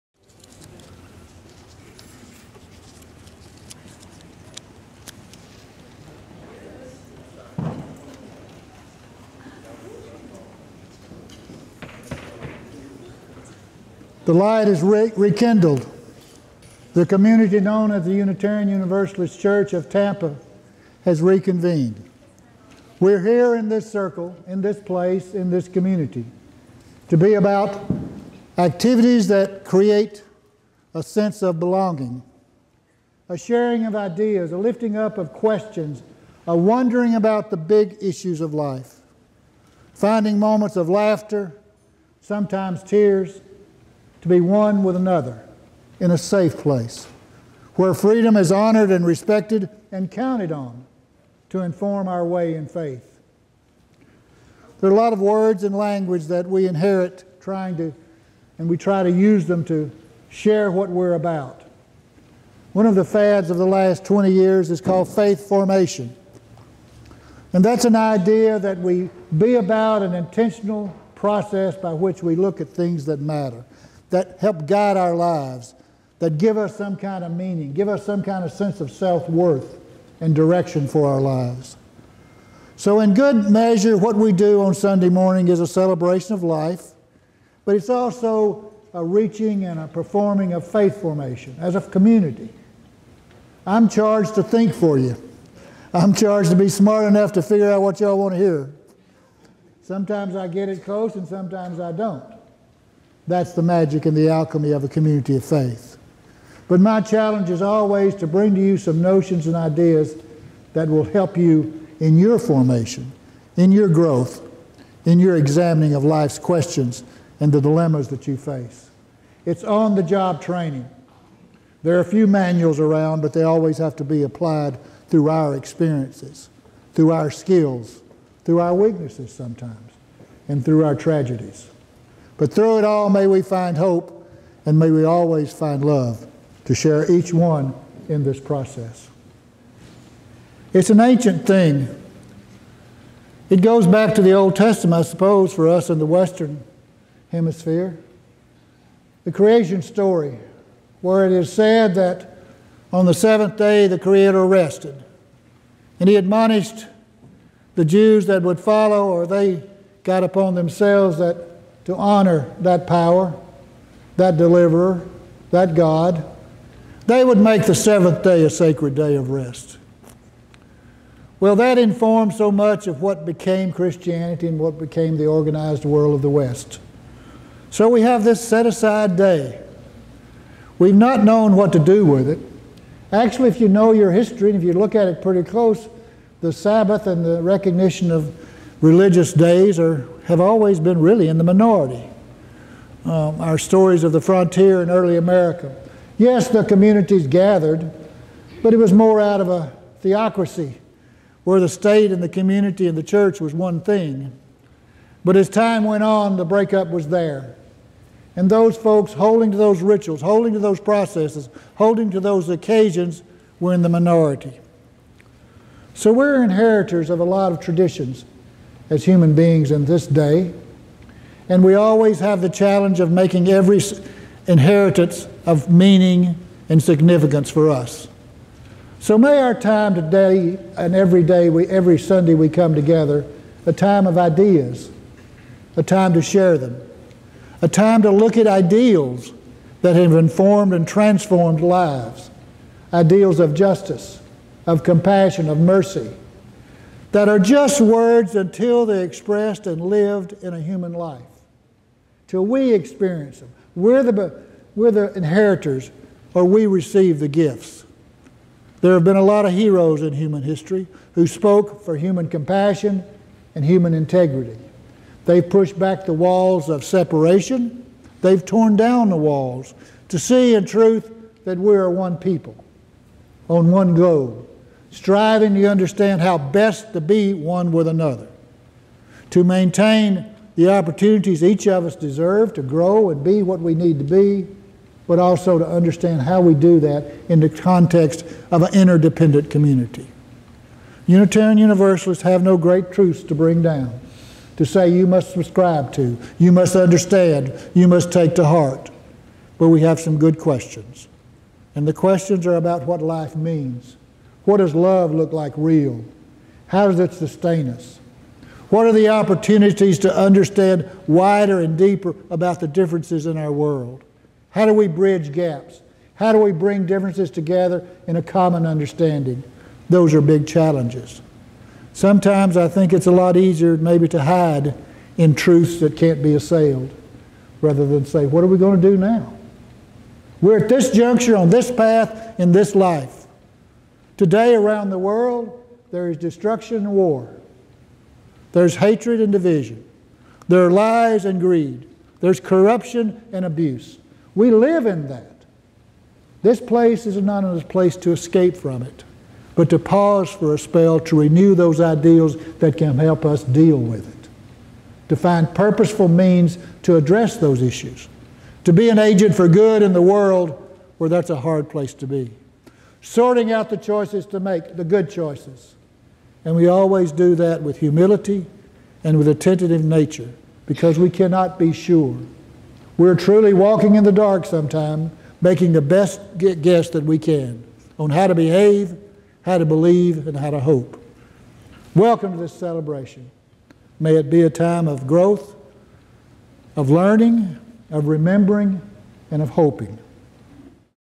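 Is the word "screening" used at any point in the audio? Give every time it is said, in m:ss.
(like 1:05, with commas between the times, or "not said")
not said.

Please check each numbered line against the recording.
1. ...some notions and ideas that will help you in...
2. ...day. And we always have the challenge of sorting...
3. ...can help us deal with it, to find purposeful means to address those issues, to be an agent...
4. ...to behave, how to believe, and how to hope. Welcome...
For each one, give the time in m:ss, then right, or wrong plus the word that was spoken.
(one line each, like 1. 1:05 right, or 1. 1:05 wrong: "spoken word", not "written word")
1. 1:48 right
2. 3:40 wrong: "making", not "sorting"
3. 5:52 right
4. 6:18 right.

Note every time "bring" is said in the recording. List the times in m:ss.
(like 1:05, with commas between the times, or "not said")
1:48, 4:53, 5:16.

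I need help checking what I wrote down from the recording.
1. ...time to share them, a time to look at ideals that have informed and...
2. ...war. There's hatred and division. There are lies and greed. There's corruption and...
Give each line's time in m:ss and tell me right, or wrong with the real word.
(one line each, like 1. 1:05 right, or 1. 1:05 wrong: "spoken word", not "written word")
1. 3:55 right
2. 5:36 right.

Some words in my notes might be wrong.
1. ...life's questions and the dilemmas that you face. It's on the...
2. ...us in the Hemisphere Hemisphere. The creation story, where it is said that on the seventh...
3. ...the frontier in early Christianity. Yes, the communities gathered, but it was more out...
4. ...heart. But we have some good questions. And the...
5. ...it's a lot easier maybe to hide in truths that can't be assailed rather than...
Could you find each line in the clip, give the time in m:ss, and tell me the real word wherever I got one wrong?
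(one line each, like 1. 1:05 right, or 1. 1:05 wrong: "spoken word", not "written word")
1. 1:56 right
2. 2:25 wrong: "Western", not "Hemisphere"
3. 3:14 wrong: "America", not "Christianity"
4. 4:58 right
5. 5:22 right.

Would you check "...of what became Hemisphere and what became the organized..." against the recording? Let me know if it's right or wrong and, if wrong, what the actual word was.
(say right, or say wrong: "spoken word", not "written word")
wrong: "Christianity", not "Hemisphere".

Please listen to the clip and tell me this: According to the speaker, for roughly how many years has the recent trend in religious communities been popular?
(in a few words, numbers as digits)
20.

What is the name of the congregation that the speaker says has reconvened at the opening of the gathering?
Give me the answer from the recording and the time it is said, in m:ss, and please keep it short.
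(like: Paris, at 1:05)
Unitarian Universalist Church of Tampa, at 0:18.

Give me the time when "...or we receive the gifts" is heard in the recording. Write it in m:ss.
4:16.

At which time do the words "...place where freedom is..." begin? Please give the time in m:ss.
0:46.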